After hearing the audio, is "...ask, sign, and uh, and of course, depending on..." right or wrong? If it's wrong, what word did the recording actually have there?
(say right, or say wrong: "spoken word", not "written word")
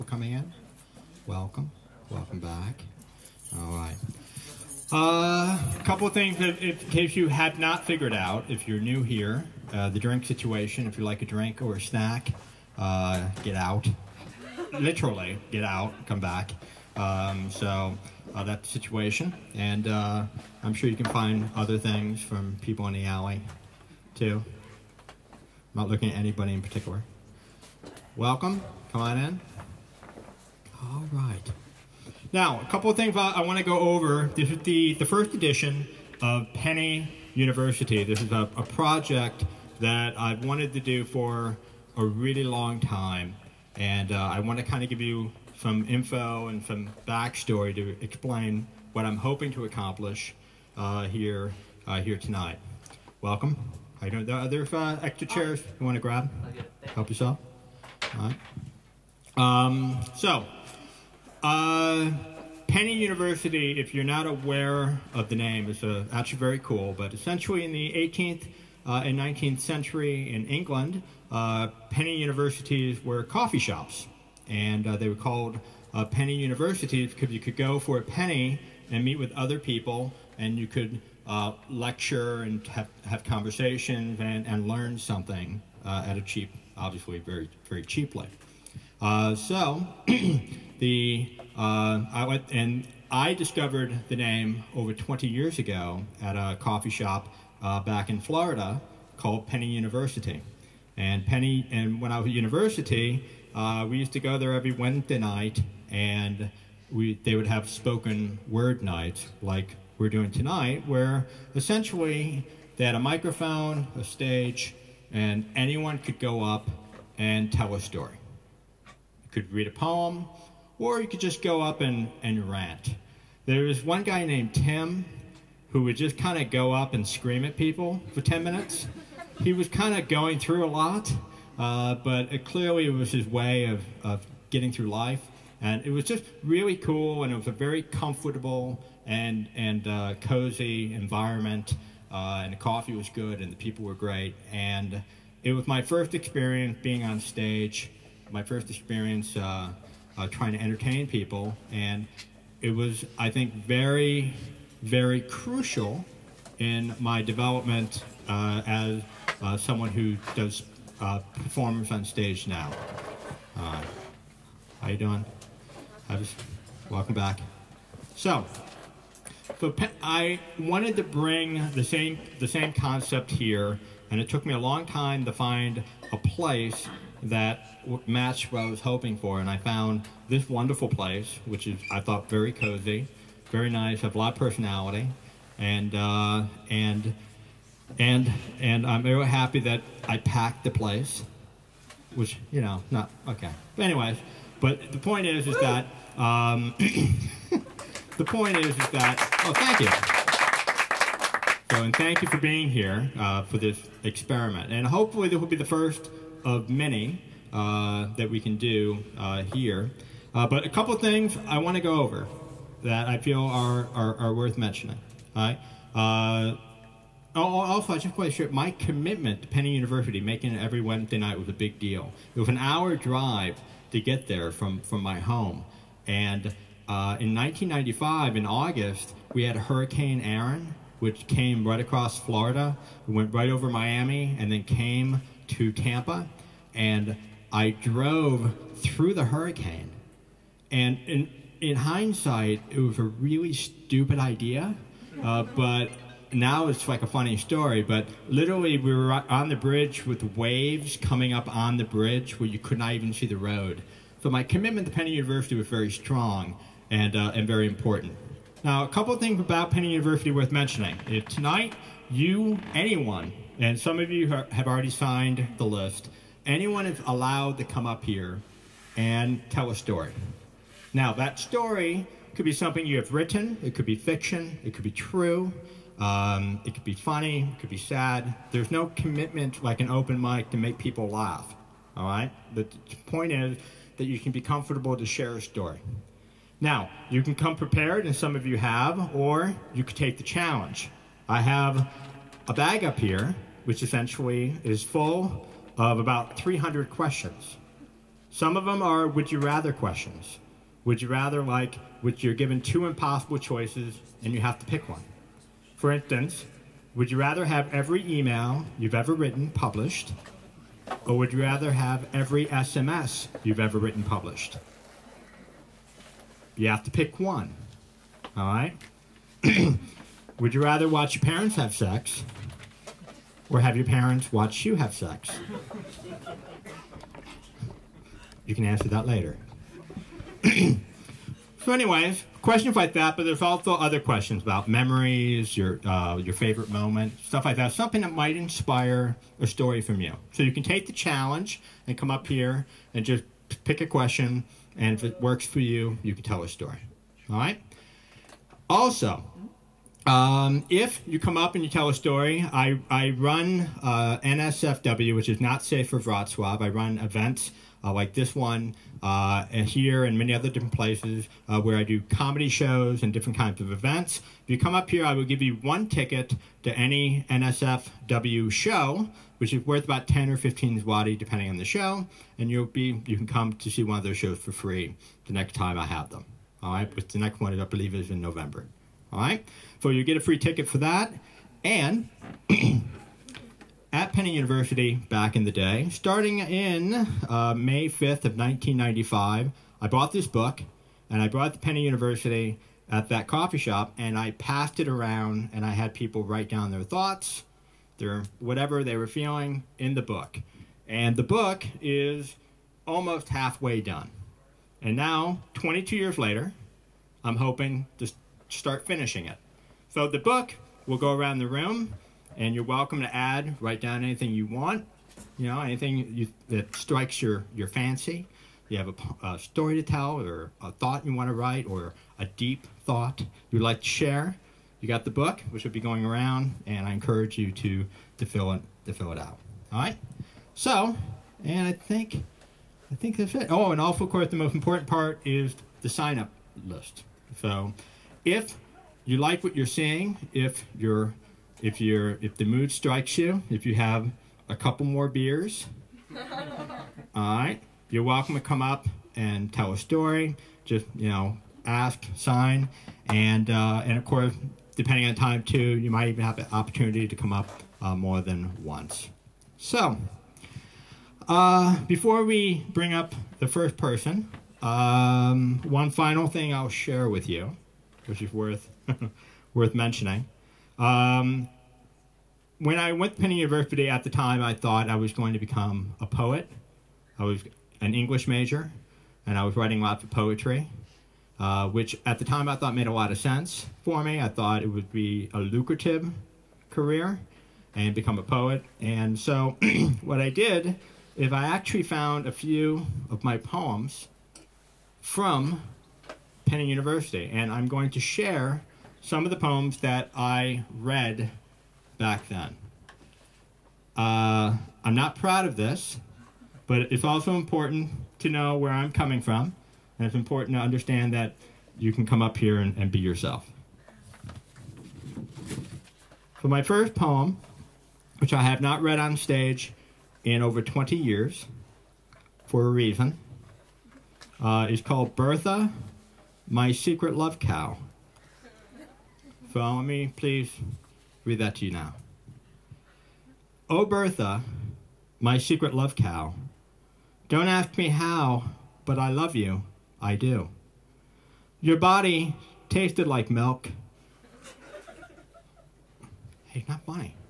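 right.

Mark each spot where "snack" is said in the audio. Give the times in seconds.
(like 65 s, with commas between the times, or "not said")
11 s.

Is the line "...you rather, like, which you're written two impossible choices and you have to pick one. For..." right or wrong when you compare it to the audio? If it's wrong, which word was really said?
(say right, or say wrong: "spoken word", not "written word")
wrong: "given", not "written".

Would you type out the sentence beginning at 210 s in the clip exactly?
Uh, but a couple of things I want to go over that I feel are, are, are worth mentioning.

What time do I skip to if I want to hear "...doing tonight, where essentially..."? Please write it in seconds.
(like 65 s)
110 s.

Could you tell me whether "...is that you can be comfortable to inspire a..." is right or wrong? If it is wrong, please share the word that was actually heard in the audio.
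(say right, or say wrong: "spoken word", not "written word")
wrong: "share", not "inspire".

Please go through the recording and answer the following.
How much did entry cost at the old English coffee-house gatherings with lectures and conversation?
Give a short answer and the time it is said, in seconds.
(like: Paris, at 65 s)
a penny, at 77 s.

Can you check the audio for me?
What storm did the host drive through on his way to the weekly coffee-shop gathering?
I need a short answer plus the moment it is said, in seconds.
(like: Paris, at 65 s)
Hurricane Erin, at 229 s.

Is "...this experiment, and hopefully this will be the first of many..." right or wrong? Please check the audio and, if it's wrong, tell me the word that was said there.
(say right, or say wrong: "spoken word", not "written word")
right.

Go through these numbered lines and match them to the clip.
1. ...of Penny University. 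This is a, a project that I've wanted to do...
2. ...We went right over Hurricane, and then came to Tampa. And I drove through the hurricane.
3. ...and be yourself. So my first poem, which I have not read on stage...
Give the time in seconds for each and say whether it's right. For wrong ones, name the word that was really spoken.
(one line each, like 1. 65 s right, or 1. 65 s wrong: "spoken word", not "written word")
1. 36 s right
2. 233 s wrong: "Miami", not "Hurricane"
3. 512 s right.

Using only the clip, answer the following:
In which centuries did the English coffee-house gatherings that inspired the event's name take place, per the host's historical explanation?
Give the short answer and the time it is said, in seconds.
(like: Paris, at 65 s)
18th and 19th century, at 67 s.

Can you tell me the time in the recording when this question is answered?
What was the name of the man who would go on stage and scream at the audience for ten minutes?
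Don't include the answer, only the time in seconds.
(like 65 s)
124 s.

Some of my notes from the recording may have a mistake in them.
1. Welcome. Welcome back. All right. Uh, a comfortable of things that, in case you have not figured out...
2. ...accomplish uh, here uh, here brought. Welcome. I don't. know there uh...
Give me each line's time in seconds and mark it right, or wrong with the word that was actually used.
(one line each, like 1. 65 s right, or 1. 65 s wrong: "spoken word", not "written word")
1. 1 s wrong: "couple", not "comfortable"
2. 49 s wrong: "tonight", not "brought".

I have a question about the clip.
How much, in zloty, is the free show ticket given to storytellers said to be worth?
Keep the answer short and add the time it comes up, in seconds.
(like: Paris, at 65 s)
10 or 15 zloty, at 370 s.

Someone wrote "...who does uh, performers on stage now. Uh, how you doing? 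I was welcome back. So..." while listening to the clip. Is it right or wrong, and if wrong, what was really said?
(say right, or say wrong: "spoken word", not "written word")
right.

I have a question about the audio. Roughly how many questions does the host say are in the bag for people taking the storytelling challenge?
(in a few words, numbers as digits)
300.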